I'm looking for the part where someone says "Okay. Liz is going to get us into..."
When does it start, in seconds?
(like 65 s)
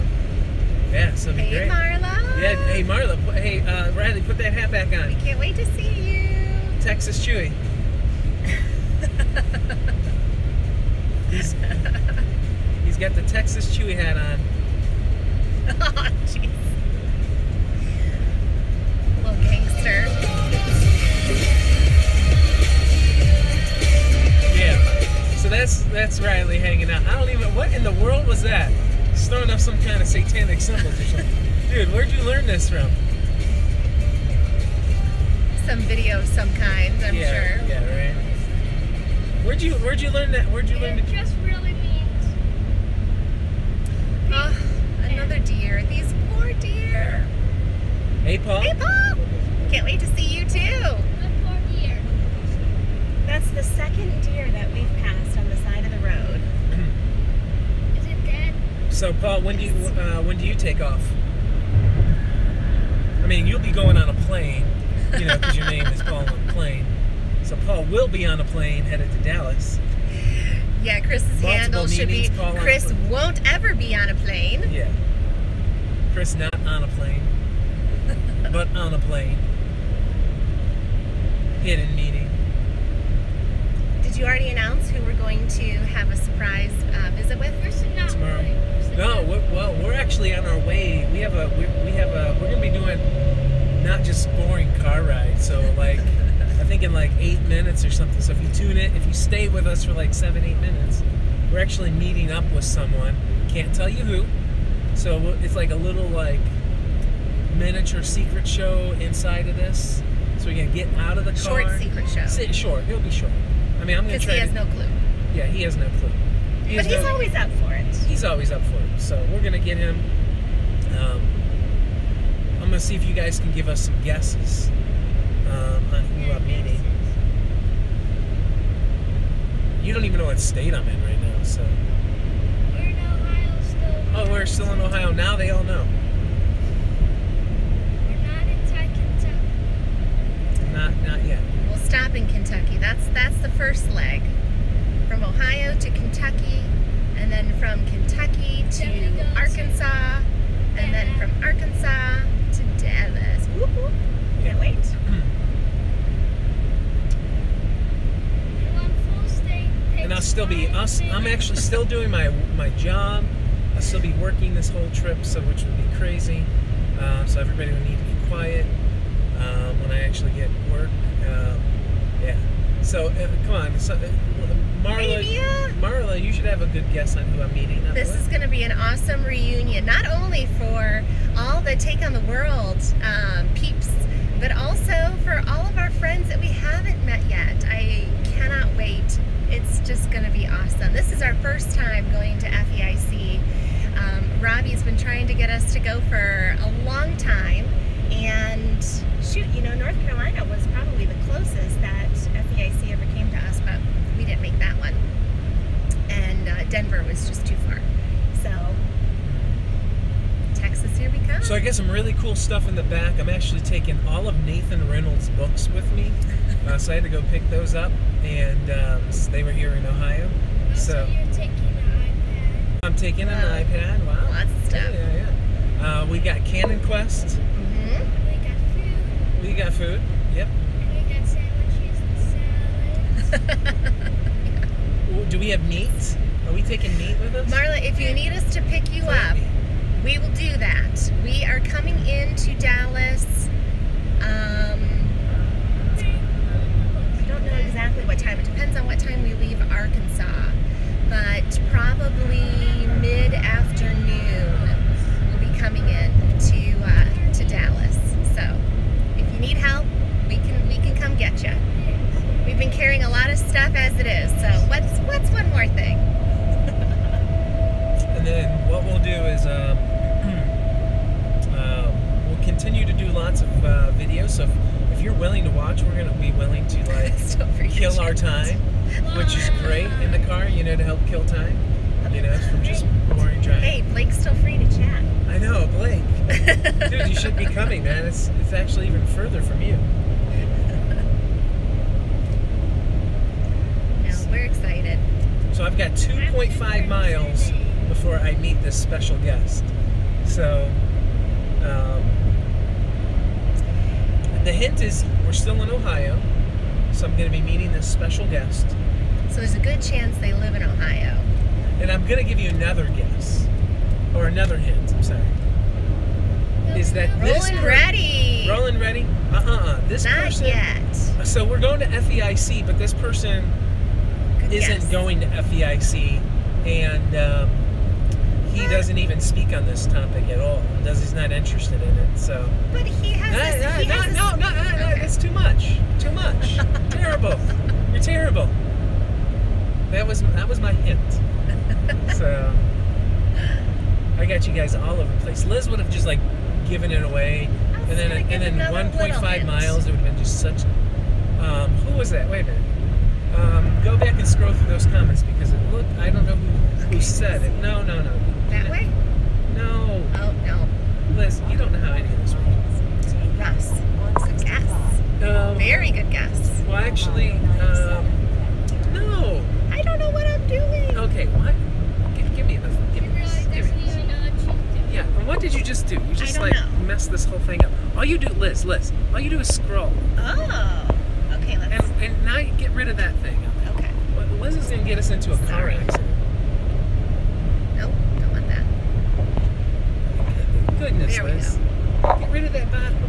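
383 s.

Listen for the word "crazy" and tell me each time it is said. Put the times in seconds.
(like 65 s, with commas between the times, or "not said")
165 s.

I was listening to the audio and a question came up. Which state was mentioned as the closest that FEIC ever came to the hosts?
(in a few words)
North Carolina.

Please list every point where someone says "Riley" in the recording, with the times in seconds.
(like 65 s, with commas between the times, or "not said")
3 s, 26 s.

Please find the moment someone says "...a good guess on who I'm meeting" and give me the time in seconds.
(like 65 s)
176 s.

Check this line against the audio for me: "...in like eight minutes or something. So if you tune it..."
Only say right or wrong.
right.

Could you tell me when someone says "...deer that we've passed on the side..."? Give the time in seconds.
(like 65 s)
54 s.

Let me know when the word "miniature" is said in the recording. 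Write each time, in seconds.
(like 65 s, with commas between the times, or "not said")
107 s.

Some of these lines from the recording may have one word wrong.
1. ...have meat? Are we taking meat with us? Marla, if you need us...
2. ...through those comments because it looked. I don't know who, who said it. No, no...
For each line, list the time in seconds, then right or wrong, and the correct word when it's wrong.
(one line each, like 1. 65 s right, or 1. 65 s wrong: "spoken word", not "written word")
1. 235 s right
2. 354 s right.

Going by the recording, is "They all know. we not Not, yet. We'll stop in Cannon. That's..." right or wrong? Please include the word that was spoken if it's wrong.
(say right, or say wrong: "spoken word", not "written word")
wrong: "Kentucky", not "Cannon".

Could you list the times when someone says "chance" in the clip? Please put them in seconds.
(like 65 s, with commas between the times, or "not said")
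309 s.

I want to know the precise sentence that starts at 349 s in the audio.
It would have been just such.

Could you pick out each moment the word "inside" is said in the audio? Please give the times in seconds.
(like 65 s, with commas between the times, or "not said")
108 s.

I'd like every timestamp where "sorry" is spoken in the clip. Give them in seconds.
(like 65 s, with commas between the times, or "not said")
315 s, 385 s.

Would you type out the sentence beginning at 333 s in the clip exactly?
No, this, he no, has no, no, no, no, no, That's too much.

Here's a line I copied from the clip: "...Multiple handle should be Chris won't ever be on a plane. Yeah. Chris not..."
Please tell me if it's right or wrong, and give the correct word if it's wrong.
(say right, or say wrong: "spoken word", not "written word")
right.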